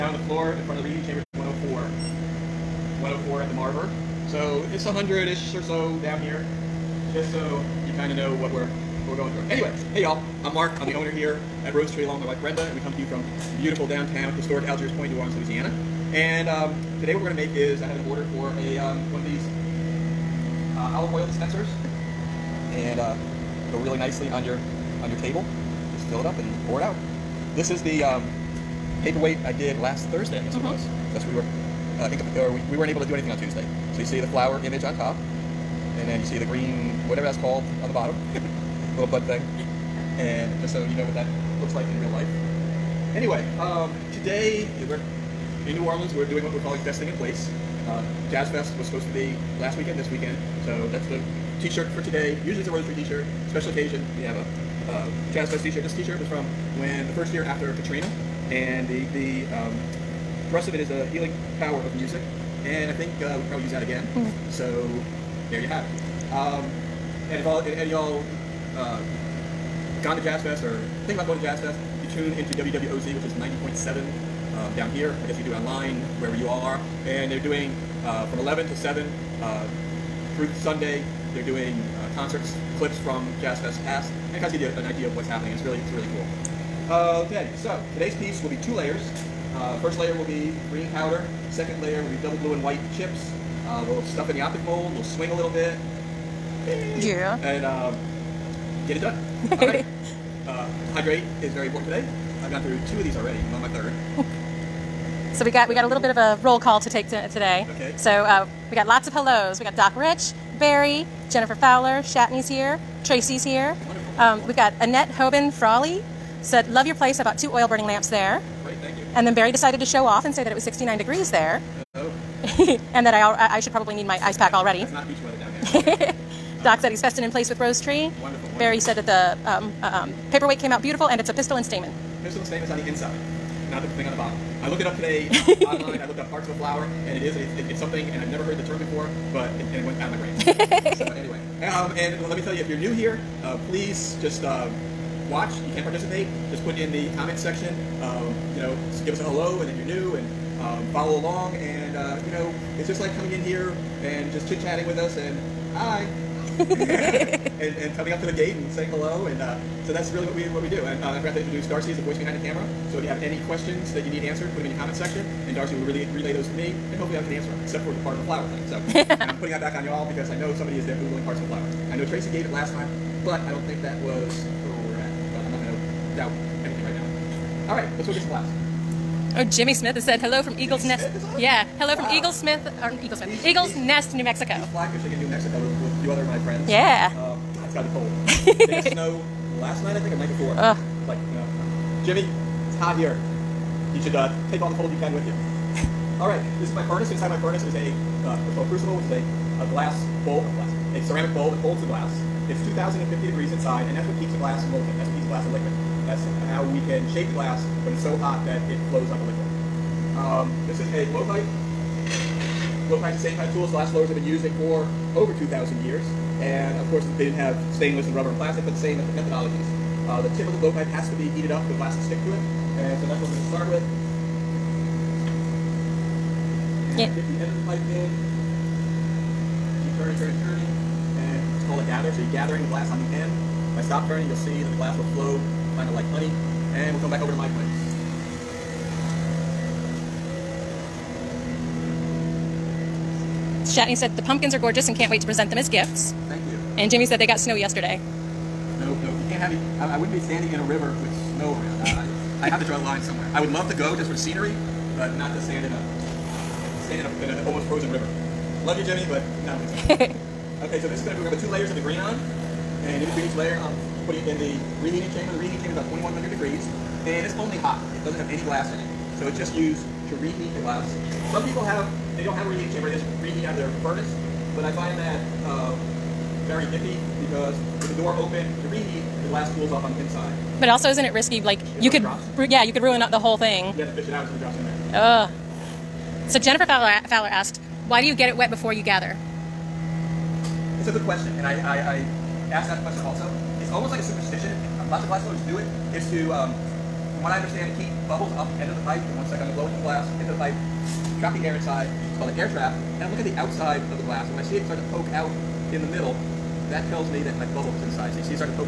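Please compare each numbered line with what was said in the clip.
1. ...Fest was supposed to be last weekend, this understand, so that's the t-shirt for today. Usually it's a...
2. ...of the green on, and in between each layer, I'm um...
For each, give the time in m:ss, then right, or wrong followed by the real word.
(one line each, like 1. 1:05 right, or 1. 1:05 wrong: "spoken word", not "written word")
1. 0:48 wrong: "weekend", not "understand"
2. 4:21 right.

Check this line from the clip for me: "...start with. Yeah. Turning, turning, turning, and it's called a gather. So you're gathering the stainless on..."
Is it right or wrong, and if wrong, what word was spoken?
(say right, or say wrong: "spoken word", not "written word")
wrong: "glass", not "stainless".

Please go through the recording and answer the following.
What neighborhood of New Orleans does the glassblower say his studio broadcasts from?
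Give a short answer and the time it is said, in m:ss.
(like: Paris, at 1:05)
Algiers Point, at 0:14.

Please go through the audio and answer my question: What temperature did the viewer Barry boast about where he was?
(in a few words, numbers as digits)
69 degrees.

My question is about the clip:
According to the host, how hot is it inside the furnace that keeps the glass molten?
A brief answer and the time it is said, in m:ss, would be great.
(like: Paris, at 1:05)
2,050 degrees, at 3:22.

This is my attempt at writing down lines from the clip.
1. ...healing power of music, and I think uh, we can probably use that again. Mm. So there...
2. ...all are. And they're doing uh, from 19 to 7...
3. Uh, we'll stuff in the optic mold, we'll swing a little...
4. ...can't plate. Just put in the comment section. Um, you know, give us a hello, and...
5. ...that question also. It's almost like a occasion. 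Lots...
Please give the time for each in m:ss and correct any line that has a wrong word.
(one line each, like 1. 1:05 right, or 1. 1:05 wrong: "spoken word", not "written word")
1. 1:01 right
2. 1:16 wrong: "11", not "19"
3. 1:33 right
4. 2:25 wrong: "participate", not "plate"
5. 4:52 wrong: "superstition", not "occasion".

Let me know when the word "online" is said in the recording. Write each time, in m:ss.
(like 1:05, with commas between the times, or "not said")
1:15, 2:15.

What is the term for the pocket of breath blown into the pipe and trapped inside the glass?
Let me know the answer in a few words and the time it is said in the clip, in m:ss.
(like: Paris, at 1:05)
air trap, at 5:02.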